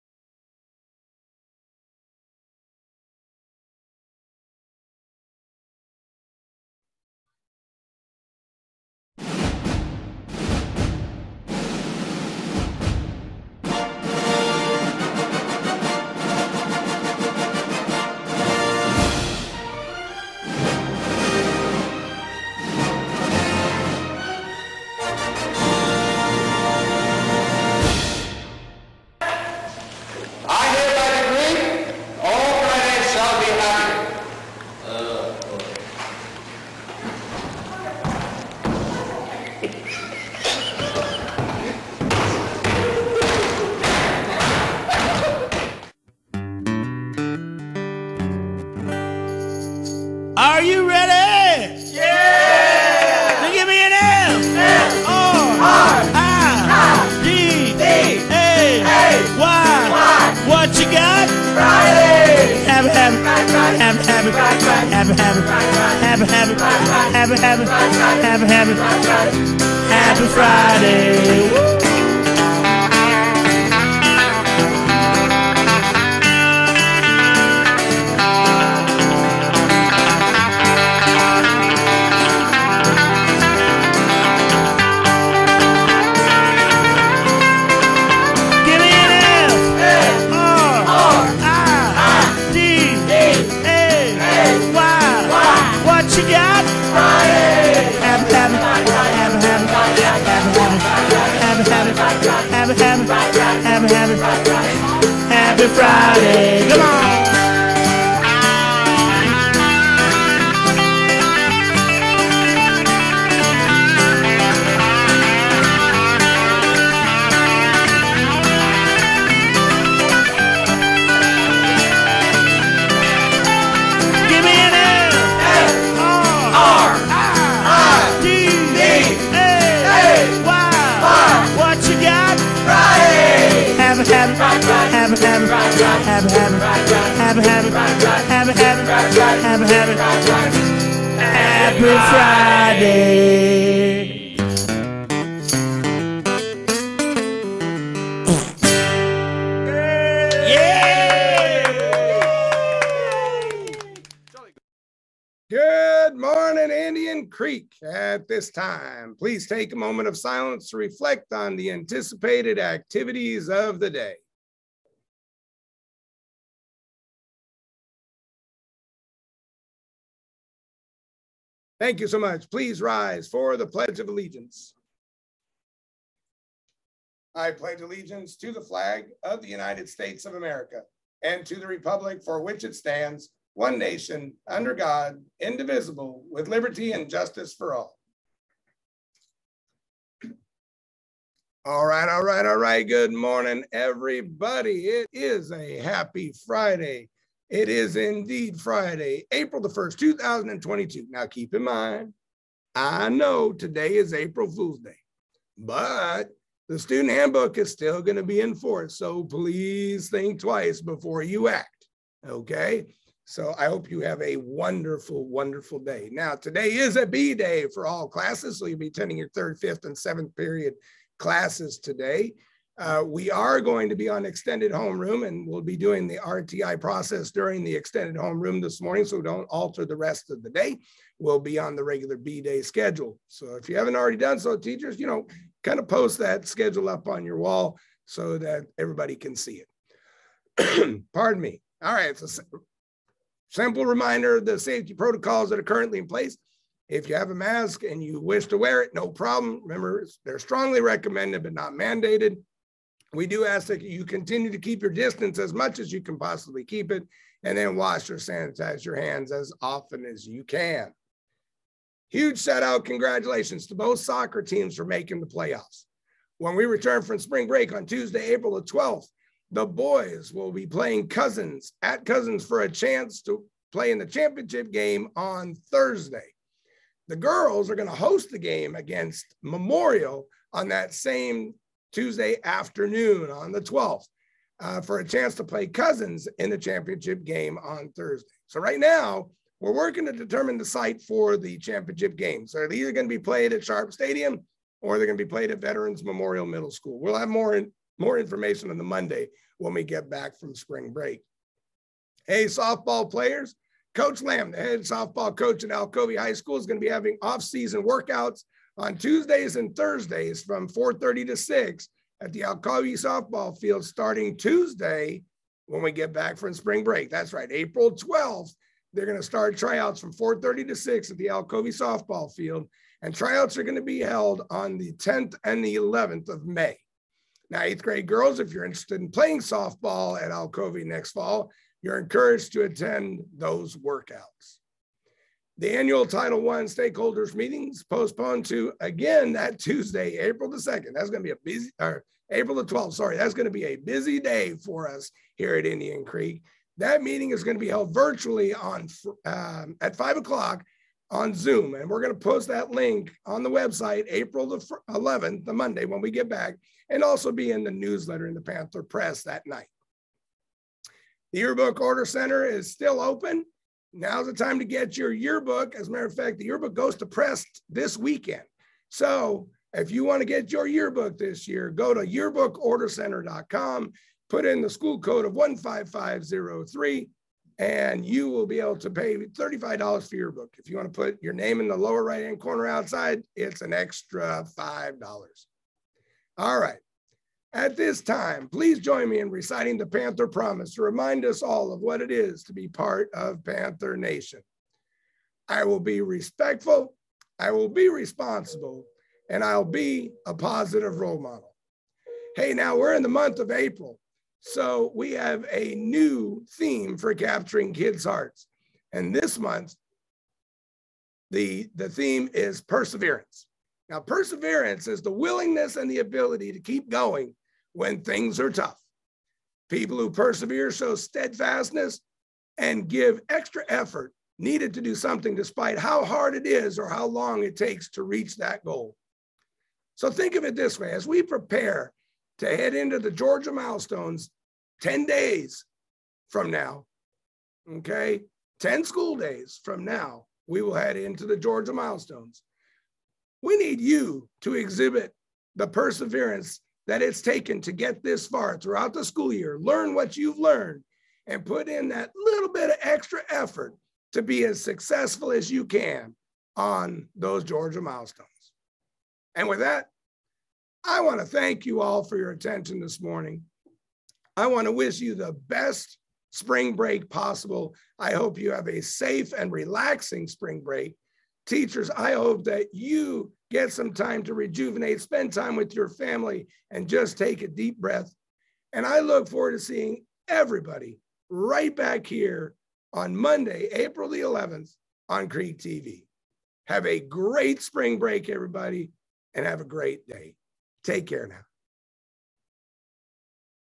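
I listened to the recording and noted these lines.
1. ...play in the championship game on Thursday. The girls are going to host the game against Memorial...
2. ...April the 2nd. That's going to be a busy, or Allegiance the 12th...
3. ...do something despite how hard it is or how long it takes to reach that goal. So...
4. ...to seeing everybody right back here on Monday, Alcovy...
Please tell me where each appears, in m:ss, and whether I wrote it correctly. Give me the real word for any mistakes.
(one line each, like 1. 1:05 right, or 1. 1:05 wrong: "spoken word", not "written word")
1. 4:33 right
2. 5:40 wrong: "April", not "Allegiance"
3. 7:04 right
4. 7:59 wrong: "April", not "Alcovy".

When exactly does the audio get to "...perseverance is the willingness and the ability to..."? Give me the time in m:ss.
6:53.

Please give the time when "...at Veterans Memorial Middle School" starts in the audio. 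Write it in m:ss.
4:55.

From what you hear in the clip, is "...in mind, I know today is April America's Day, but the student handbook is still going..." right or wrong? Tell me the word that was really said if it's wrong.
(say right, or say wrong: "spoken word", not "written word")
wrong: "Fool", not "America".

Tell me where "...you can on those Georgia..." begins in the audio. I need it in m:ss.
7:35.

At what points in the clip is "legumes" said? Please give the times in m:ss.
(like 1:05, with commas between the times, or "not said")
not said.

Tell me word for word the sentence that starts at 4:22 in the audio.
Huge shout out, congratulations to both soccer teams for making the playoffs.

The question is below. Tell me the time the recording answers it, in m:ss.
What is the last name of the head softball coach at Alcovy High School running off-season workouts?
5:03.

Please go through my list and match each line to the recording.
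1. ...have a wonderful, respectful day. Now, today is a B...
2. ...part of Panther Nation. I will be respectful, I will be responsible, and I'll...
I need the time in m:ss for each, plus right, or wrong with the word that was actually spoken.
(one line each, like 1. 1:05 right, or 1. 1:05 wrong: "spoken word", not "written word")
1. 3:33 wrong: "wonderful", not "respectful"
2. 6:32 right.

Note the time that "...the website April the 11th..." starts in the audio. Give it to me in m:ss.
5:53.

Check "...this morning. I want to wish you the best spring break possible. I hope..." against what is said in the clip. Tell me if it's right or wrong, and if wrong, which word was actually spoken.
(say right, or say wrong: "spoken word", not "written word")
right.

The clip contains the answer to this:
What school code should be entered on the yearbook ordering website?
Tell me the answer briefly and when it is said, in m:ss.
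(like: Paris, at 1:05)
15503, at 6:15.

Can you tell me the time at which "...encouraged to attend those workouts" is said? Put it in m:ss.
5:31.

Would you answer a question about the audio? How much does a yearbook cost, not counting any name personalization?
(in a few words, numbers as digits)
$35.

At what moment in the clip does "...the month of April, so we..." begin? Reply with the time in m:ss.
6:43.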